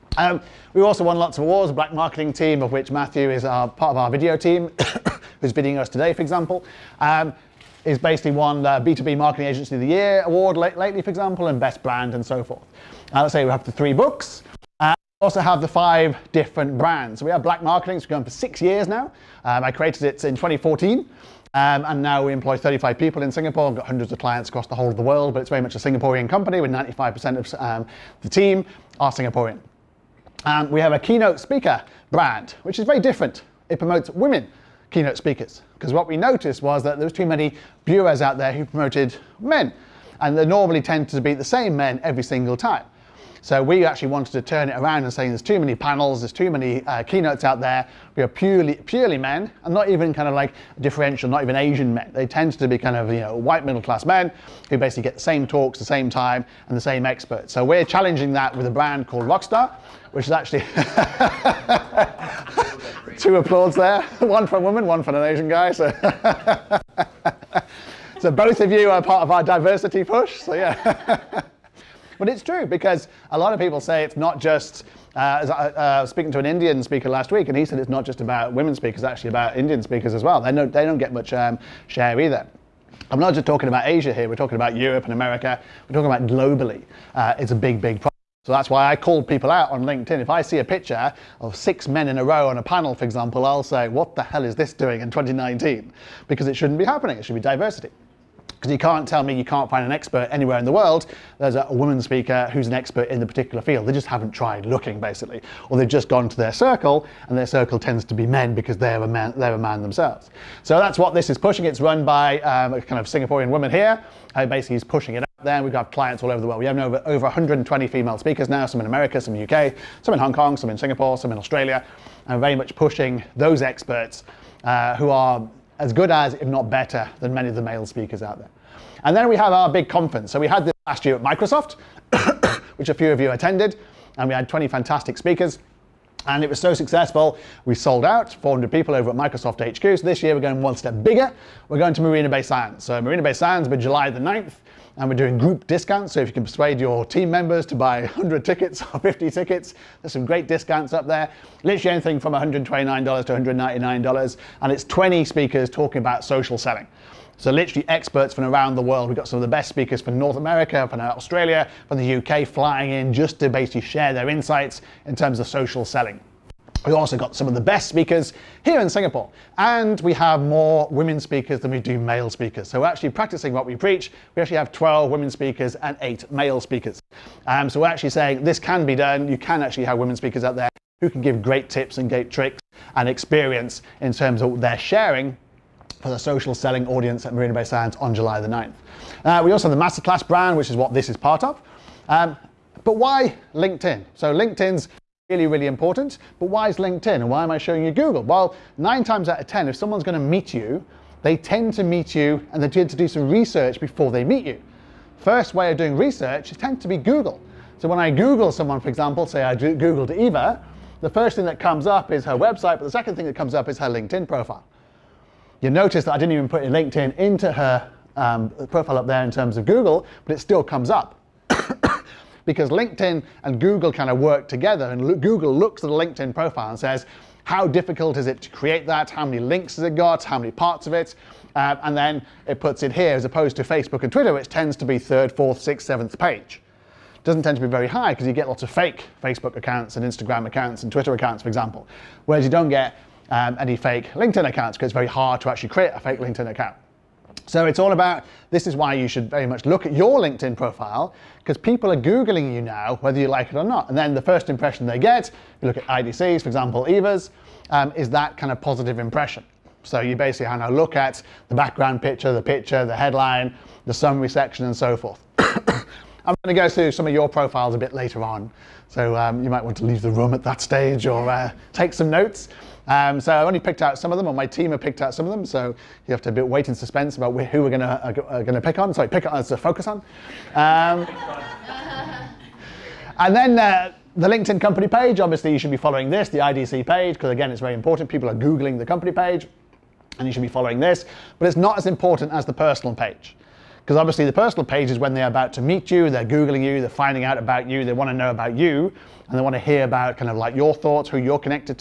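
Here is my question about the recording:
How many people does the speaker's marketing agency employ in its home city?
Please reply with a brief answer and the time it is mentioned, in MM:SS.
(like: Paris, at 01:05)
35, at 00:22.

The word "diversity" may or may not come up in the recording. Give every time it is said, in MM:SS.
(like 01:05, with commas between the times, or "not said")
01:09, 01:37.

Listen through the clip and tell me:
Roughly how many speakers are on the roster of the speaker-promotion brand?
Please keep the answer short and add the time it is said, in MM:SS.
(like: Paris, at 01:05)
120, at 01:57.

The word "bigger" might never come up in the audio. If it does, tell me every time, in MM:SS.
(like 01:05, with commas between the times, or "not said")
02:21.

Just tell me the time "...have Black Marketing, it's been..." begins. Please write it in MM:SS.
00:17.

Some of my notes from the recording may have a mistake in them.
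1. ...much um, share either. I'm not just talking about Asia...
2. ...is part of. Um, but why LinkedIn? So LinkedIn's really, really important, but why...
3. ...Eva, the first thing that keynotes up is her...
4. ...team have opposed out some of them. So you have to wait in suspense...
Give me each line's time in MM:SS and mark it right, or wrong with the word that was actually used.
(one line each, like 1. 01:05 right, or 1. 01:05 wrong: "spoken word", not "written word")
1. 01:21 right
2. 03:11 right
3. 03:30 wrong: "comes", not "keynotes"
4. 04:34 wrong: "picked", not "opposed".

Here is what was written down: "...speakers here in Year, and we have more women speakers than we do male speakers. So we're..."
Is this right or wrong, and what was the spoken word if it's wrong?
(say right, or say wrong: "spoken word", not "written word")
wrong: "Singapore", not "Year".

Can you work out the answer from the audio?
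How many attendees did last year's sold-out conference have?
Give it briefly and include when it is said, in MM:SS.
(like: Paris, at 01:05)
400, at 02:18.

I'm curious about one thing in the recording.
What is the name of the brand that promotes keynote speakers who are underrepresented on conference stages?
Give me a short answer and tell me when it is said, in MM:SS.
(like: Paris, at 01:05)
Rockstar, at 00:59.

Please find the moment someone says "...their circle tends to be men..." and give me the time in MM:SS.
01:47.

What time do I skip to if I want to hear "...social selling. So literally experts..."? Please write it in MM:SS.
02:36.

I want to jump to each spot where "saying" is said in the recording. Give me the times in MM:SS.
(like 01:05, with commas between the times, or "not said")
00:45, 02:58.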